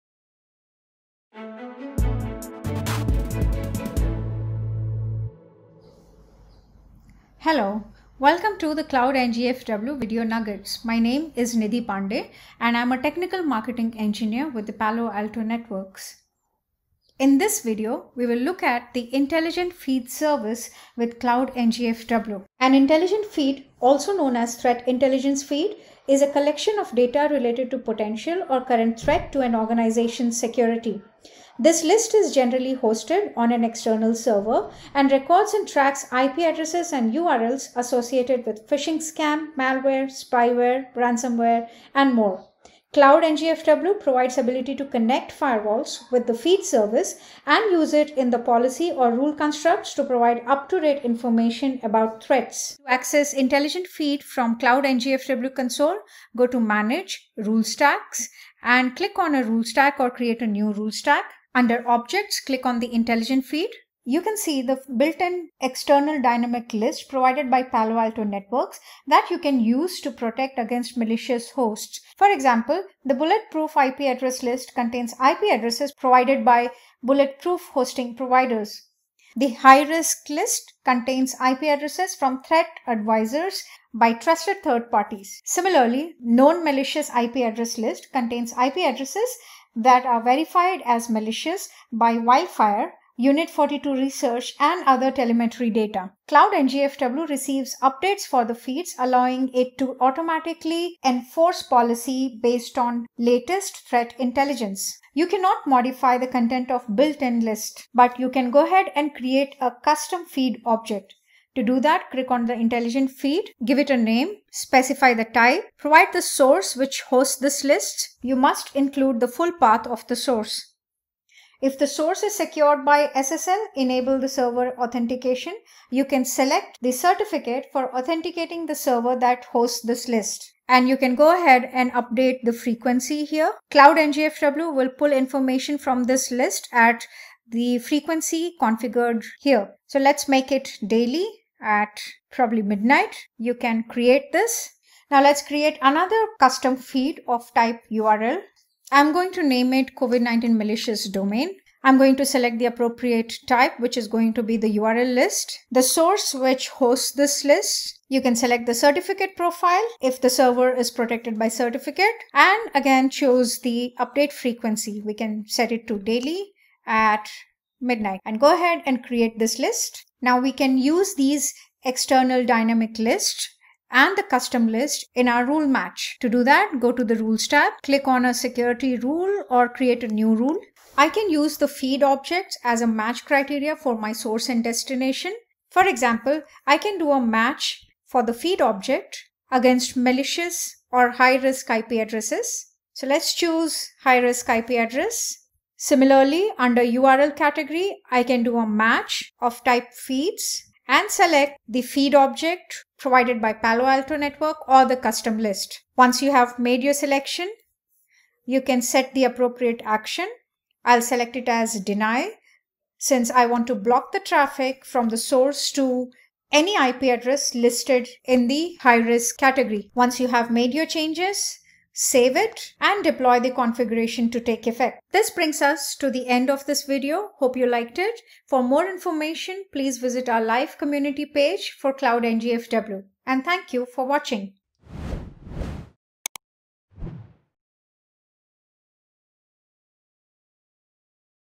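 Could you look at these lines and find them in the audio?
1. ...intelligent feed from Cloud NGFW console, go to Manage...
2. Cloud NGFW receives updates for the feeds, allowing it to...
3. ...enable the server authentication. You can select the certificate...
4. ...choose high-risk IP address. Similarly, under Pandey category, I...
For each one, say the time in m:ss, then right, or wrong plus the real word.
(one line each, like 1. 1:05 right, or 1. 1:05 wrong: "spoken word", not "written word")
1. 0:53 right
2. 1:36 right
3. 2:03 right
4. 3:13 wrong: "URL", not "Pandey".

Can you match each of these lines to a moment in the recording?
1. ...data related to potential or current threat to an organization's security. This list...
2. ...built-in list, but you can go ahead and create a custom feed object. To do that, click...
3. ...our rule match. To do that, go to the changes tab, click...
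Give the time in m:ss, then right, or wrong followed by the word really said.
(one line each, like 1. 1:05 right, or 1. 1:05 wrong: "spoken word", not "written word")
1. 0:26 right
2. 1:46 right
3. 2:55 wrong: "rules", not "changes".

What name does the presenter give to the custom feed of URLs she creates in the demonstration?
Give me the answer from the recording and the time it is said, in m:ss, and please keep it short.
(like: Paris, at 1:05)
COVID-19 malicious domain, at 2:29.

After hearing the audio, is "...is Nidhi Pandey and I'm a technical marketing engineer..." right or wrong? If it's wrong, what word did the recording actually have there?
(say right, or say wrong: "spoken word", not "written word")
right.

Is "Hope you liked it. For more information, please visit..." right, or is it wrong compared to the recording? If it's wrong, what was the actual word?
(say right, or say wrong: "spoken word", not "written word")
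right.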